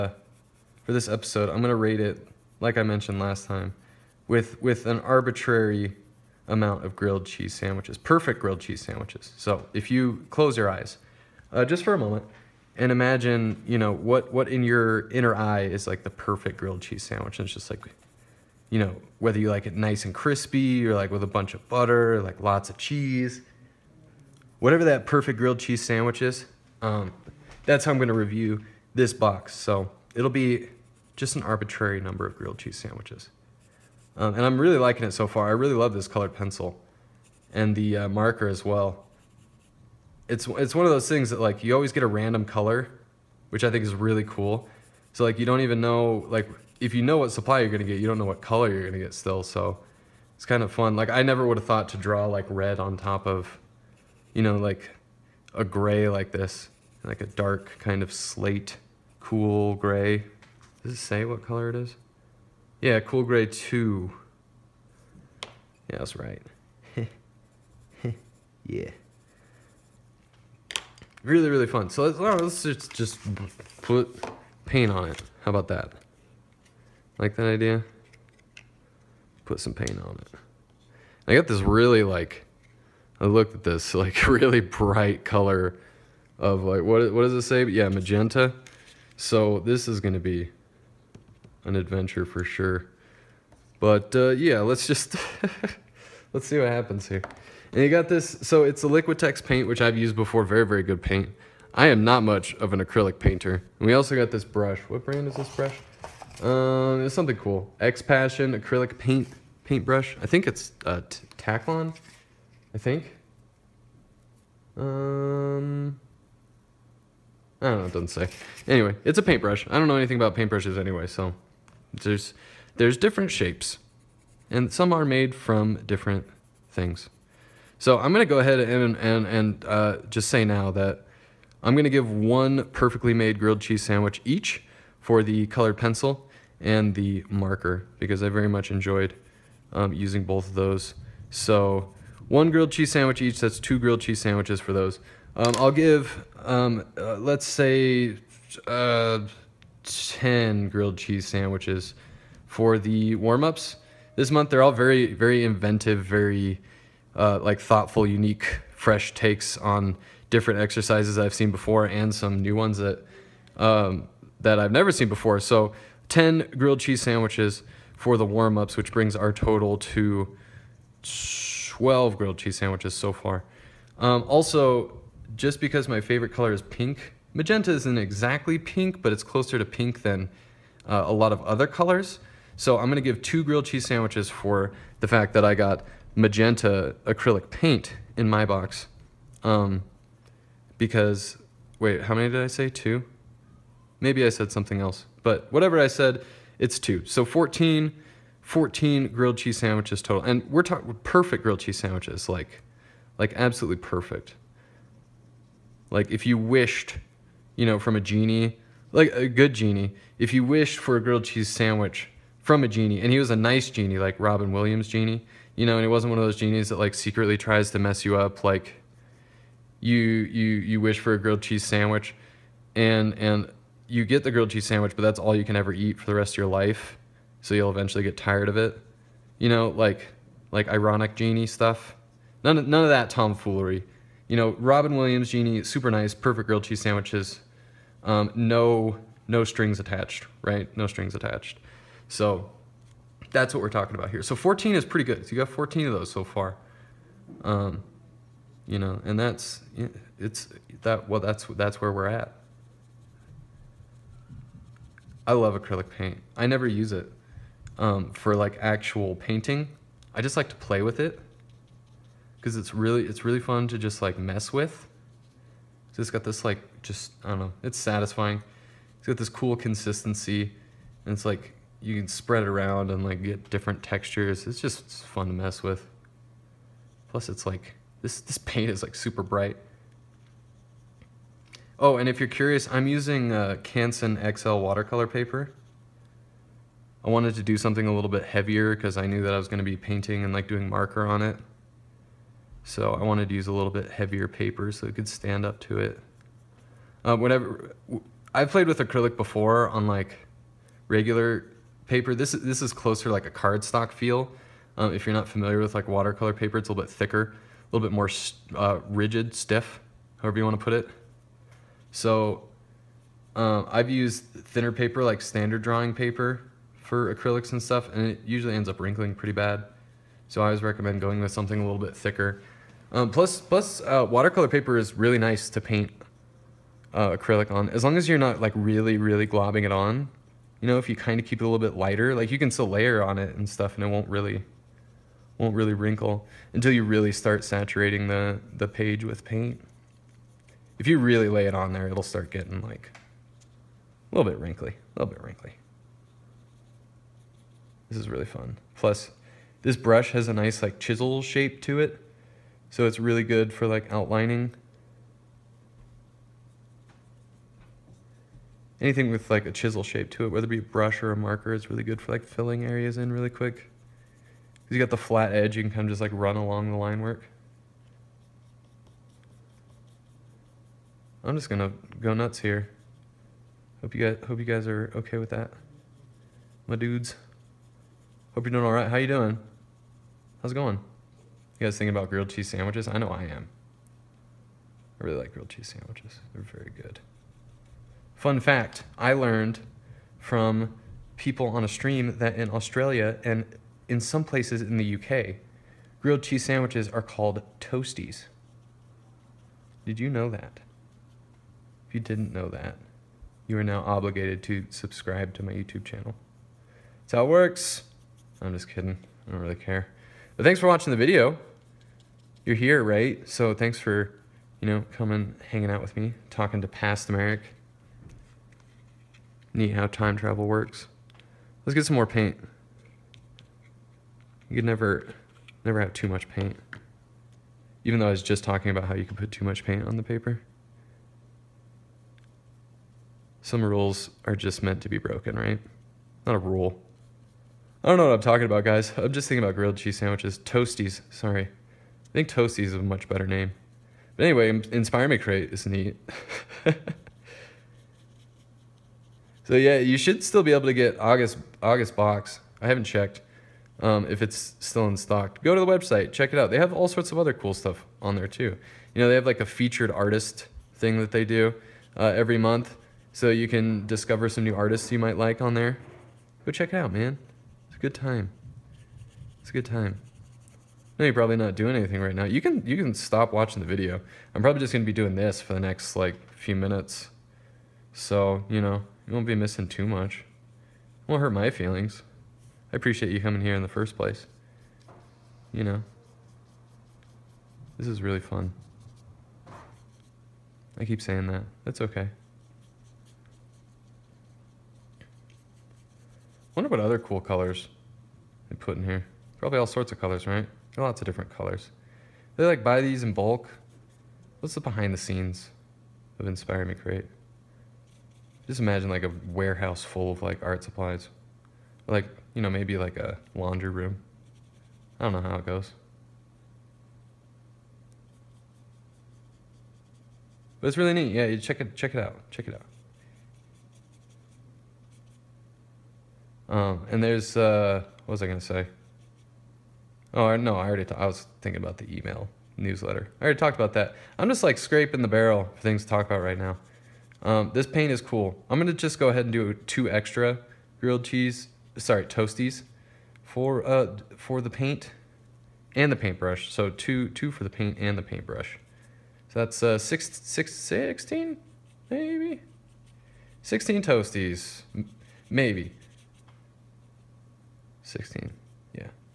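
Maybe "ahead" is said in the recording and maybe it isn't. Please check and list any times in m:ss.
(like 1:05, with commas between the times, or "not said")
2:08, 8:59.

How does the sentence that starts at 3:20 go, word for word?
And we're talking perfect grilled cheese sandwiches, like, like absolutely perfect.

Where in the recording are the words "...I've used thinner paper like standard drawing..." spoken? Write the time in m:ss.
5:13.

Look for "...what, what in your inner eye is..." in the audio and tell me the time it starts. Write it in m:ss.
0:13.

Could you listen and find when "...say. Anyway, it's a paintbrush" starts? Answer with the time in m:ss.
1:58.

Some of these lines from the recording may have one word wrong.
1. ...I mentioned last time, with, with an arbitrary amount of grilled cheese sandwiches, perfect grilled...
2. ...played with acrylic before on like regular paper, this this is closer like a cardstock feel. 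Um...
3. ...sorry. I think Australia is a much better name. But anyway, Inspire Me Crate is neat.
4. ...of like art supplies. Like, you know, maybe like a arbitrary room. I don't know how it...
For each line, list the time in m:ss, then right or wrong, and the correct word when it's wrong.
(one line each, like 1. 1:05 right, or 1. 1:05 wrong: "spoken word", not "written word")
1. 0:02 right
2. 4:58 right
3. 7:21 wrong: "Toasties", not "Australia"
4. 8:30 wrong: "laundry", not "arbitrary".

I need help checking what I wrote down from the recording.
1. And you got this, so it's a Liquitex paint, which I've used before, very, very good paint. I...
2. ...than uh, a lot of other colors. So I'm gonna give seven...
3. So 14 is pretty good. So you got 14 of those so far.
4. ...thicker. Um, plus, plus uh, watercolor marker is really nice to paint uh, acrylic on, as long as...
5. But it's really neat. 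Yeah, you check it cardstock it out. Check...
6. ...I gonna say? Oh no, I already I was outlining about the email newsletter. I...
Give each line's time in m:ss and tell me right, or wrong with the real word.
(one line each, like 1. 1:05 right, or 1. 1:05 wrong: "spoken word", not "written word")
1. 1:37 right
2. 3:00 wrong: "two", not "seven"
3. 4:04 right
4. 5:21 wrong: "paper", not "marker"
5. 8:40 wrong: "check", not "cardstock"
6. 8:48 wrong: "thinking", not "outlining".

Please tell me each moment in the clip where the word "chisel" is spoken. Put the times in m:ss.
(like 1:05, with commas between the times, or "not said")
5:50, 5:59.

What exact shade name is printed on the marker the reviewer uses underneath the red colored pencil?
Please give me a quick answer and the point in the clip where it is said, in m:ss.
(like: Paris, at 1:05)
cool gray 2, at 1:02.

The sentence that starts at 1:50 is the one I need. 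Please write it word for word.
I think it's uh, Taklon, I think.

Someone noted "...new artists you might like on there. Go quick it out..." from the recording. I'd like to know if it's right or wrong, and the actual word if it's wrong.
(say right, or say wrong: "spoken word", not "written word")
wrong: "check", not "quick".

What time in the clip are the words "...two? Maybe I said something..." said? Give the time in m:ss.
3:12.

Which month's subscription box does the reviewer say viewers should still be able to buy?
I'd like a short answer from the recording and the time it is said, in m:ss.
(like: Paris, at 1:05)
August, at 7:31.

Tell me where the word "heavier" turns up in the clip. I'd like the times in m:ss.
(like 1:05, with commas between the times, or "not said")
4:48, 4:53.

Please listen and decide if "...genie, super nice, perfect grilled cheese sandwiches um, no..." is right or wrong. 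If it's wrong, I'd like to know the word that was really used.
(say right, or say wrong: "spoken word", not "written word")
right.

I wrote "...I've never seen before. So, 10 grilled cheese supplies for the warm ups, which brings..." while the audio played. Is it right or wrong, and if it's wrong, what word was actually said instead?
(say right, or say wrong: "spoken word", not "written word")
wrong: "sandwiches", not "supplies".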